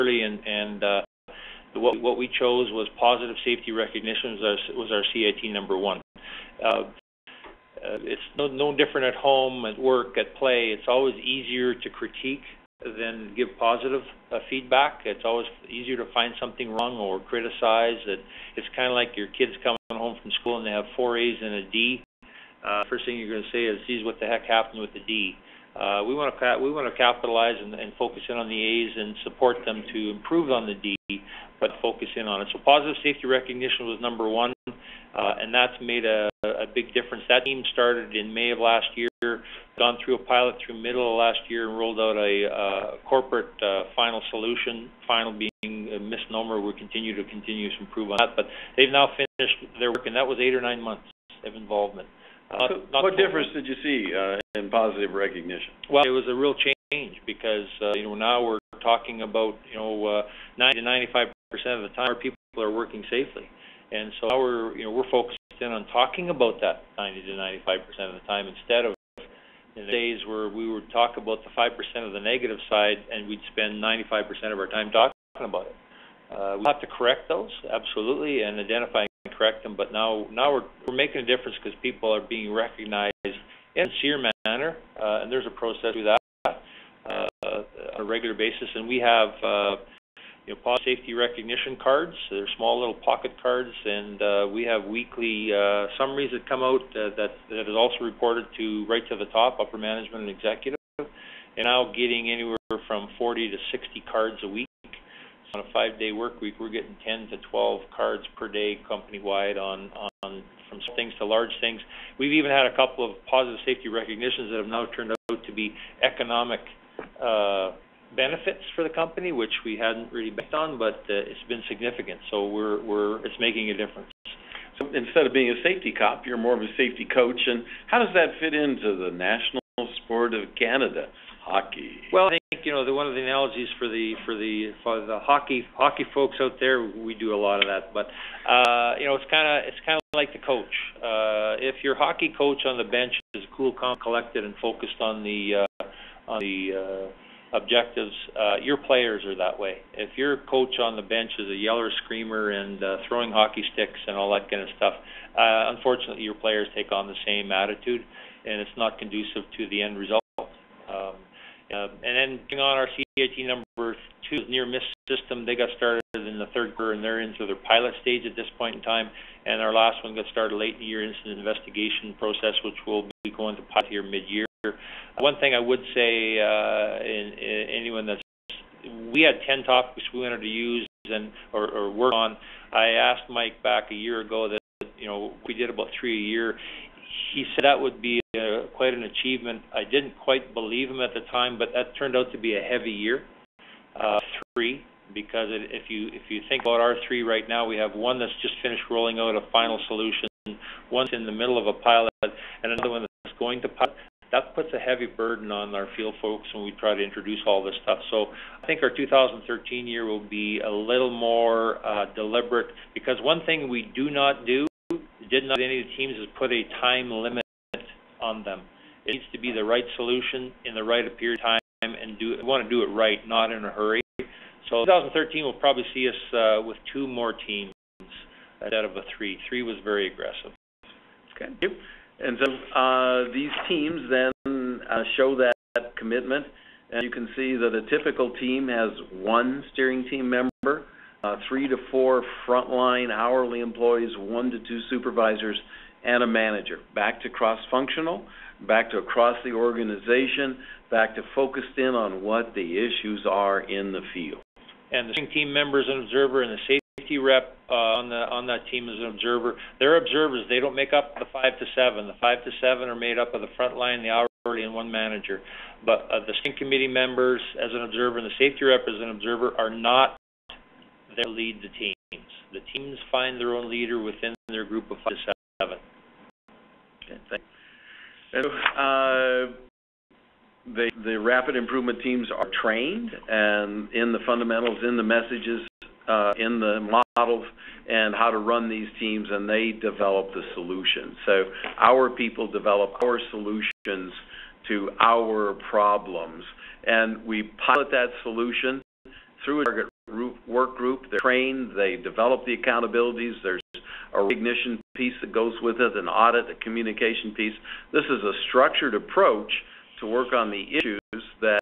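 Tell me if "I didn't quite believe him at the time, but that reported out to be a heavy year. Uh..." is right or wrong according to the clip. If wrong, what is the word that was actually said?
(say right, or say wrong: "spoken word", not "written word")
wrong: "turned", not "reported".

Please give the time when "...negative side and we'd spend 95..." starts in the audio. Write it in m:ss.
1:12.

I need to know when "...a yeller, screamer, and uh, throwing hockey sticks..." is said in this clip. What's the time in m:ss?
2:31.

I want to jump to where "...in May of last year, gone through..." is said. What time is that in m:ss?
0:38.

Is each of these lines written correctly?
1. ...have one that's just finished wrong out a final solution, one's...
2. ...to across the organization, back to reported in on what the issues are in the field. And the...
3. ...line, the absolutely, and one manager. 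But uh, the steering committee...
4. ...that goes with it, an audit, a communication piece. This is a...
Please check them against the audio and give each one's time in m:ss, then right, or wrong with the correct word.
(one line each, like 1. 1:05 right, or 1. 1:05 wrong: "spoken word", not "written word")
1. 3:17 wrong: "rolling", not "wrong"
2. 4:08 wrong: "focused", not "reported"
3. 4:23 wrong: "hourly", not "absolutely"
4. 5:05 right.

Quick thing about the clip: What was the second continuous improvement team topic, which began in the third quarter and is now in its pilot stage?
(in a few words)
near miss system.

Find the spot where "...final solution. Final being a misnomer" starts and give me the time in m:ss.
0:43.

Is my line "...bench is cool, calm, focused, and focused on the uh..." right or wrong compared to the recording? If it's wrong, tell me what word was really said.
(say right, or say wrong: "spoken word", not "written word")
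wrong: "collected", not "focused".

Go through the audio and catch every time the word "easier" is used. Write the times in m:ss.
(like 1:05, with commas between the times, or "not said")
0:11, 0:15.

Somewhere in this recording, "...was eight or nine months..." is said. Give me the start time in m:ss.
0:50.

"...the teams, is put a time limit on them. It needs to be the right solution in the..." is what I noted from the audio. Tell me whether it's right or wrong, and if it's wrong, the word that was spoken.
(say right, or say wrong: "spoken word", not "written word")
right.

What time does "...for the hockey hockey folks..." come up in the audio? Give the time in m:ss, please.
2:14.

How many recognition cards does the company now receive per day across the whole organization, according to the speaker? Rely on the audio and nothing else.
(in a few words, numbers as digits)
10 to 12.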